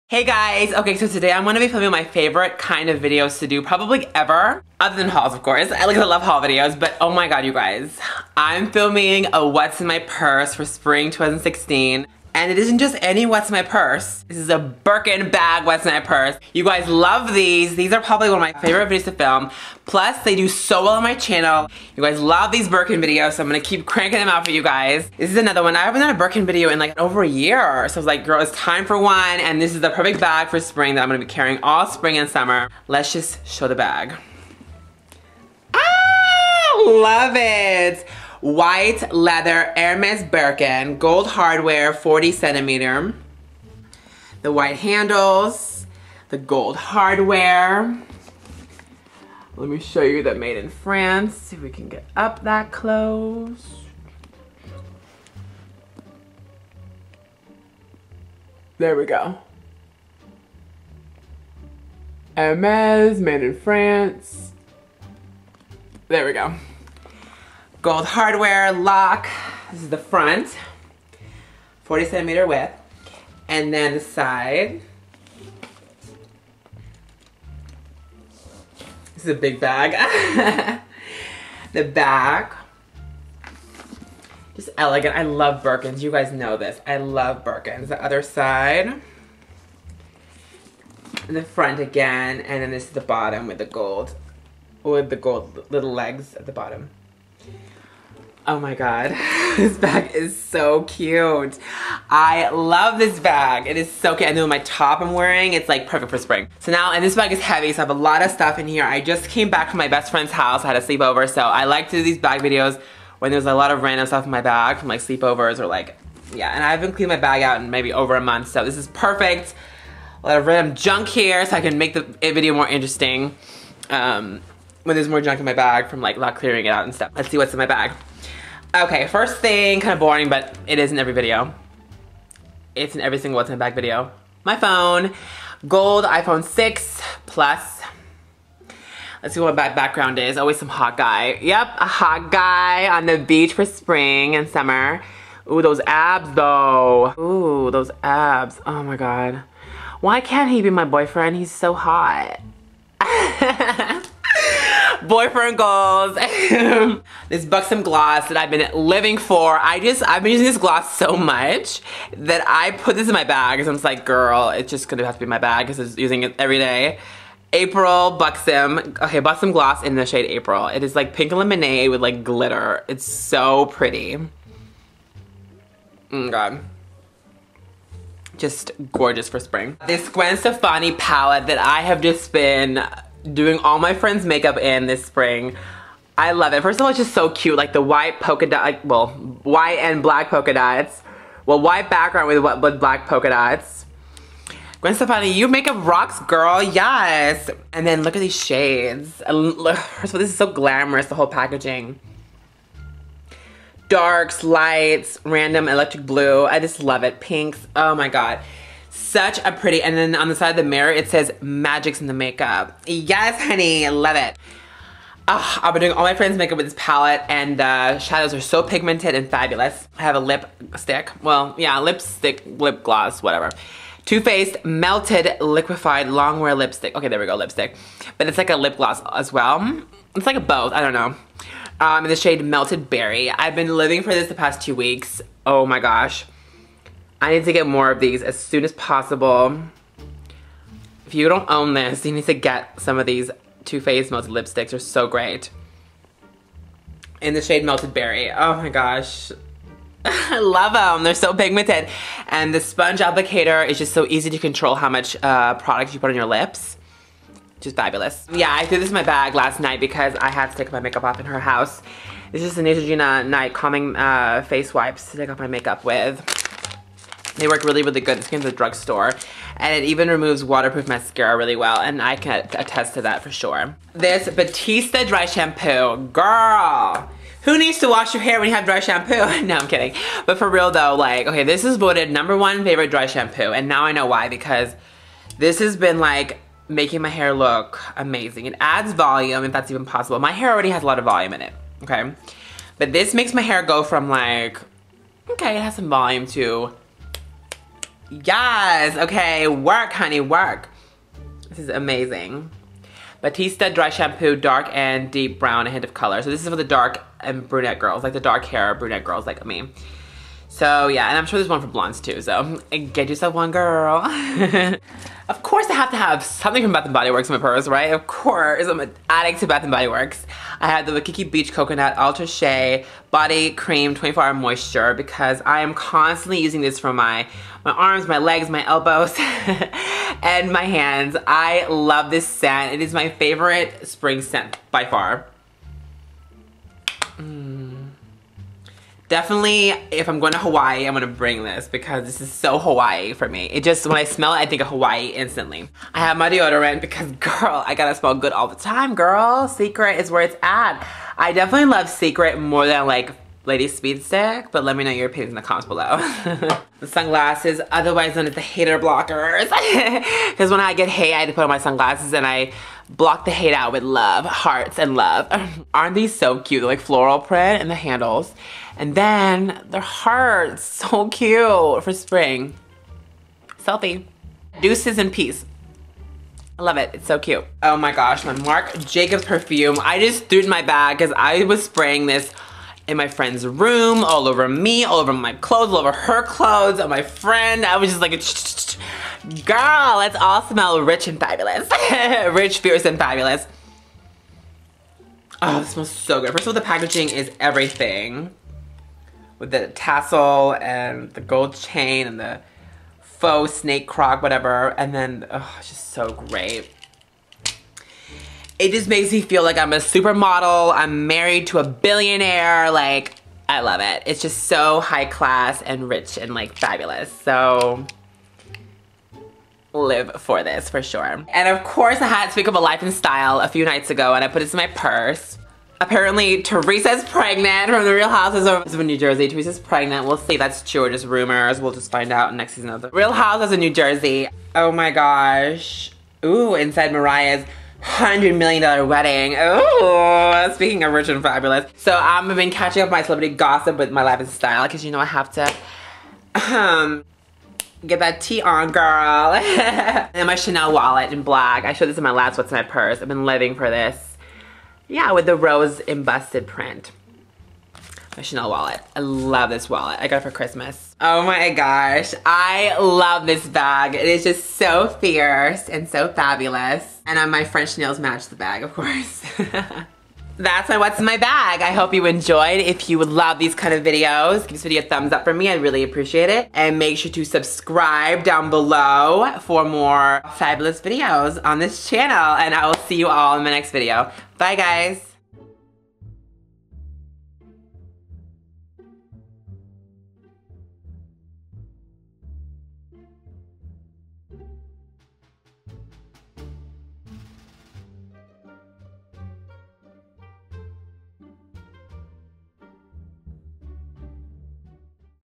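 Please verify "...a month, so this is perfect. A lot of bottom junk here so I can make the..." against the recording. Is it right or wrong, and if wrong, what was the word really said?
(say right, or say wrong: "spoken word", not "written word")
wrong: "random", not "bottom".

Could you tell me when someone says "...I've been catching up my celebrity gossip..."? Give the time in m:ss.
7:21.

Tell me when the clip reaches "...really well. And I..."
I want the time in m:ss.
4:31.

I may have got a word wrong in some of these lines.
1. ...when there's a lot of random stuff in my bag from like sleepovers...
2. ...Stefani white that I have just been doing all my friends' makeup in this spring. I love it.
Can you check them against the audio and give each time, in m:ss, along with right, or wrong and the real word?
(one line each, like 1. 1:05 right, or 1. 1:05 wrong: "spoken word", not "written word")
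1. 1:53 right
2. 3:00 wrong: "palette", not "white".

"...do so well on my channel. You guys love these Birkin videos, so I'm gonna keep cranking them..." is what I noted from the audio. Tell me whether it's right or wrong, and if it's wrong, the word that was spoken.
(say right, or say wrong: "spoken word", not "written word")
right.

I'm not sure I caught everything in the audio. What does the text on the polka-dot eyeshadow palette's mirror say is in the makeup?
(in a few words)
Magic.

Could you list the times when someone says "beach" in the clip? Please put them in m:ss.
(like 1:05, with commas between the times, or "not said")
2:23, 5:21.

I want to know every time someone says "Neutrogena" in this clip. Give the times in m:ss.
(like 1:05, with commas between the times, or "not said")
4:22.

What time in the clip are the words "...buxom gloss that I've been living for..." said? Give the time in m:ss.
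2:37.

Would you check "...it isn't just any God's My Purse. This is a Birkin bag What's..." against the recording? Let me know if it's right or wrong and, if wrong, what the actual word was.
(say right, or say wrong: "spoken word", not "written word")
wrong: "What", not "God".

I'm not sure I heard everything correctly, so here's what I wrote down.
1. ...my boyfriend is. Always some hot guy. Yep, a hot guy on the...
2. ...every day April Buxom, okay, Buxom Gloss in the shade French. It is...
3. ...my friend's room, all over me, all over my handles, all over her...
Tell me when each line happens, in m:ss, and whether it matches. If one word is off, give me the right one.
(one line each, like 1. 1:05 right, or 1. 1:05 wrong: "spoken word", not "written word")
1. 2:19 wrong: "background", not "boyfriend"
2. 2:46 wrong: "April", not "French"
3. 6:22 wrong: "clothes", not "handles".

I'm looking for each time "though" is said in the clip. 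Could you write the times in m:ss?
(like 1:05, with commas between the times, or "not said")
2:26, 4:40.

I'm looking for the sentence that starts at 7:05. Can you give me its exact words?
Apparently Teresa's pregnant from The Real Housewives of New Jersey.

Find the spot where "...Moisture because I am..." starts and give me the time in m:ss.
5:24.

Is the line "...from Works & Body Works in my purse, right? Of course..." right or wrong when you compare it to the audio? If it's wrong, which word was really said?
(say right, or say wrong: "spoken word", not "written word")
wrong: "Bath", not "Works".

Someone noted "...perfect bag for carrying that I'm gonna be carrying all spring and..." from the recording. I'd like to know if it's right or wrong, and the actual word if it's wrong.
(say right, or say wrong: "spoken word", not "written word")
wrong: "spring", not "carrying".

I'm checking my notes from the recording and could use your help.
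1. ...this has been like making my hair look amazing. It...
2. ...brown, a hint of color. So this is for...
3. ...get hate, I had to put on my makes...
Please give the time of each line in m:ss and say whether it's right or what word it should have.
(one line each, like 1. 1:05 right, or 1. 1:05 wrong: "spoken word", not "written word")
1. 4:45 right
2. 5:05 right
3. 6:00 wrong: "sunglasses", not "makes".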